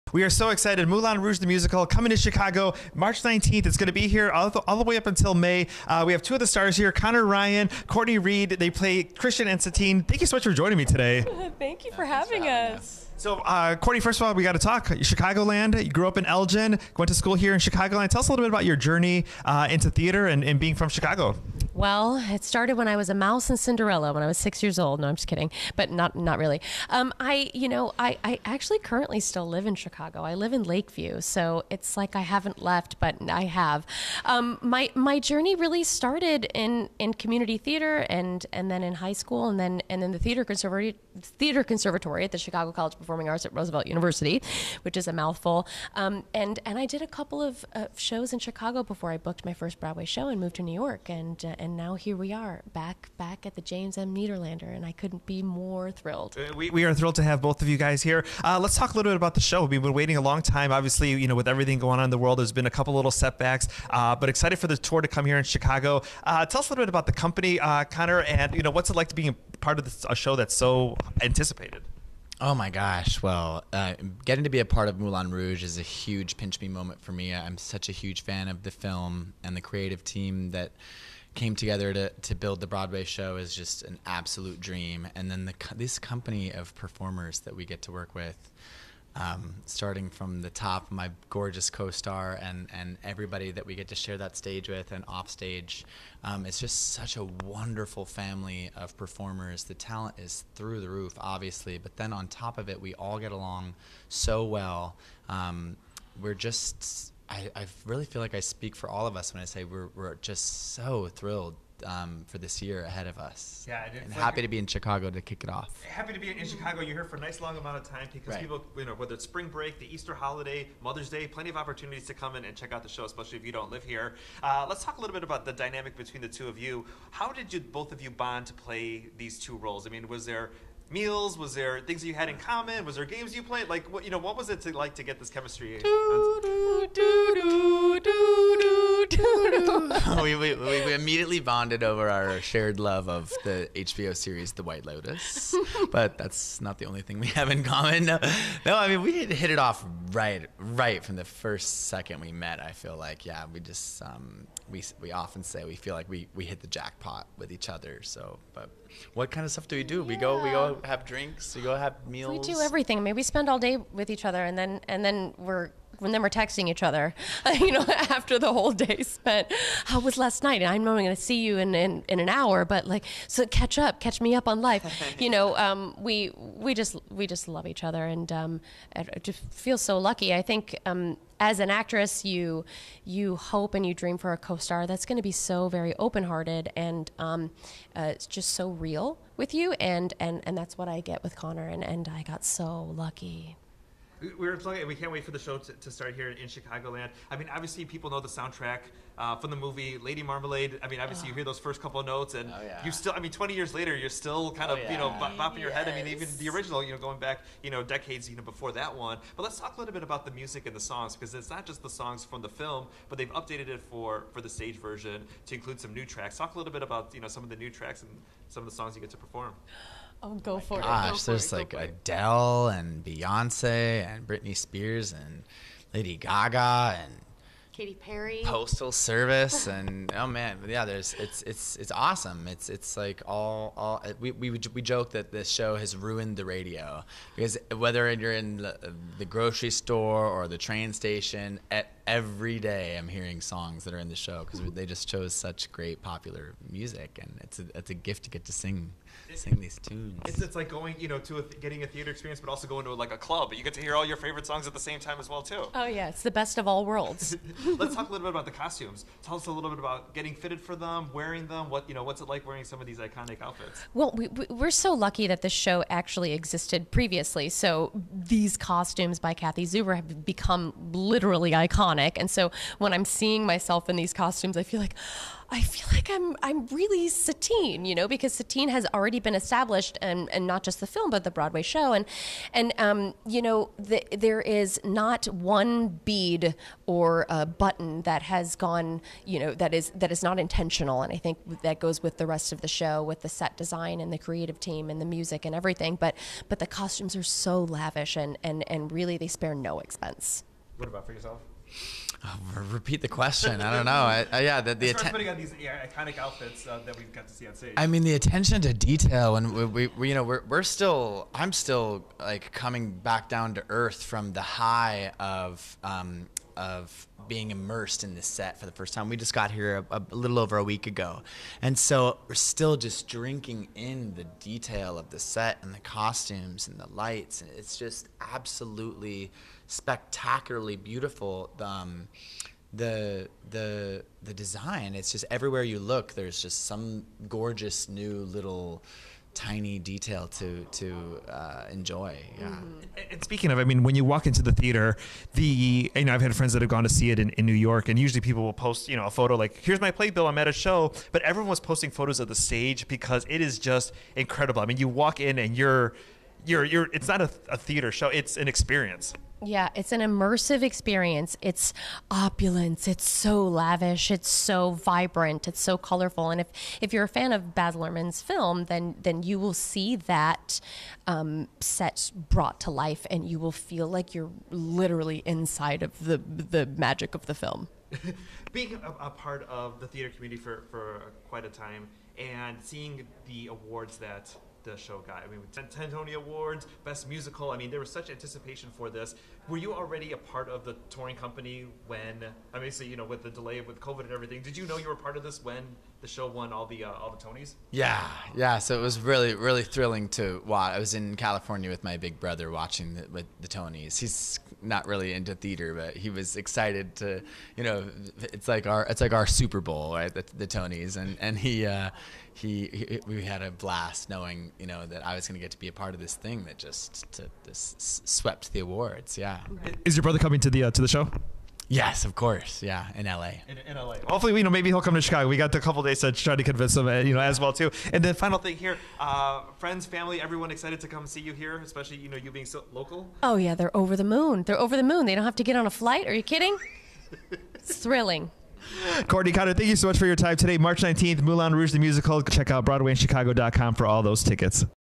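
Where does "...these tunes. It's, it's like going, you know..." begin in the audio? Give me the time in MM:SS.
04:09.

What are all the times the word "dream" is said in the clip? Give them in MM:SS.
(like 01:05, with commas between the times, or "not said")
01:24, 03:03.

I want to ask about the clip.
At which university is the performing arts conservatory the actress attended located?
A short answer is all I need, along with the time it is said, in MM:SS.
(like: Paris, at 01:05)
Roosevelt University, at 00:43.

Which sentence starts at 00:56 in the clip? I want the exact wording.
Uh, we, we are thrilled to have both of you guys here.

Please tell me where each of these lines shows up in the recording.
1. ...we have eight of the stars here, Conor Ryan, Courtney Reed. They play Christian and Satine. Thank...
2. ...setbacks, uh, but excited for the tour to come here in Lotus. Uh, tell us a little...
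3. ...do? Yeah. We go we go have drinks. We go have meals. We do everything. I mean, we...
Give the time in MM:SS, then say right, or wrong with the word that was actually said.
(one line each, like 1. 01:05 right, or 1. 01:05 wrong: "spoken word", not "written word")
1. 00:06 wrong: "two", not "eight"
2. 01:03 wrong: "Chicago", not "Lotus"
3. 02:39 right.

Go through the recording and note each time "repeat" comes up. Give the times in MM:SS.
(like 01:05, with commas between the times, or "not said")
05:02.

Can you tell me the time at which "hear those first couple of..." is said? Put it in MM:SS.
03:21.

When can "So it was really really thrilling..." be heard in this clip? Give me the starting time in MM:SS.
06:38.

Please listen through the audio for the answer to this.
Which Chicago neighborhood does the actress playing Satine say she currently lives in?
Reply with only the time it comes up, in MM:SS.
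00:30.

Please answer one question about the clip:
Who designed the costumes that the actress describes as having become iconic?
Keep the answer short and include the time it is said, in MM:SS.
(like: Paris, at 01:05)
Kathy Zuber, at 04:29.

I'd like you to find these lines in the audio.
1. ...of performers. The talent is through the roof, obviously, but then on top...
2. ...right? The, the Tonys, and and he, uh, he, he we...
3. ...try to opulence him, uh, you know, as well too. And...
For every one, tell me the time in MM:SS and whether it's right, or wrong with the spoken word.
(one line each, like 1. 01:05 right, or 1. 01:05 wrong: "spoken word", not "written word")
1. 01:38 right
2. 06:49 right
3. 07:06 wrong: "convince", not "opulence".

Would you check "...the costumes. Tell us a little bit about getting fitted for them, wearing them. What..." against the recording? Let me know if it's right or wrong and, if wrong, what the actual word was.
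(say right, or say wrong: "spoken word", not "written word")
right.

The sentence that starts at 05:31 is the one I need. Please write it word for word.
Um, the the the design it's just everywhere you look there's just some gorgeous new little tiny detail to to uh, enjoy.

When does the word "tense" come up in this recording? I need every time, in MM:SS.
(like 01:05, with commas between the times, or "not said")
not said.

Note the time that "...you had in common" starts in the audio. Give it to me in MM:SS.
02:12.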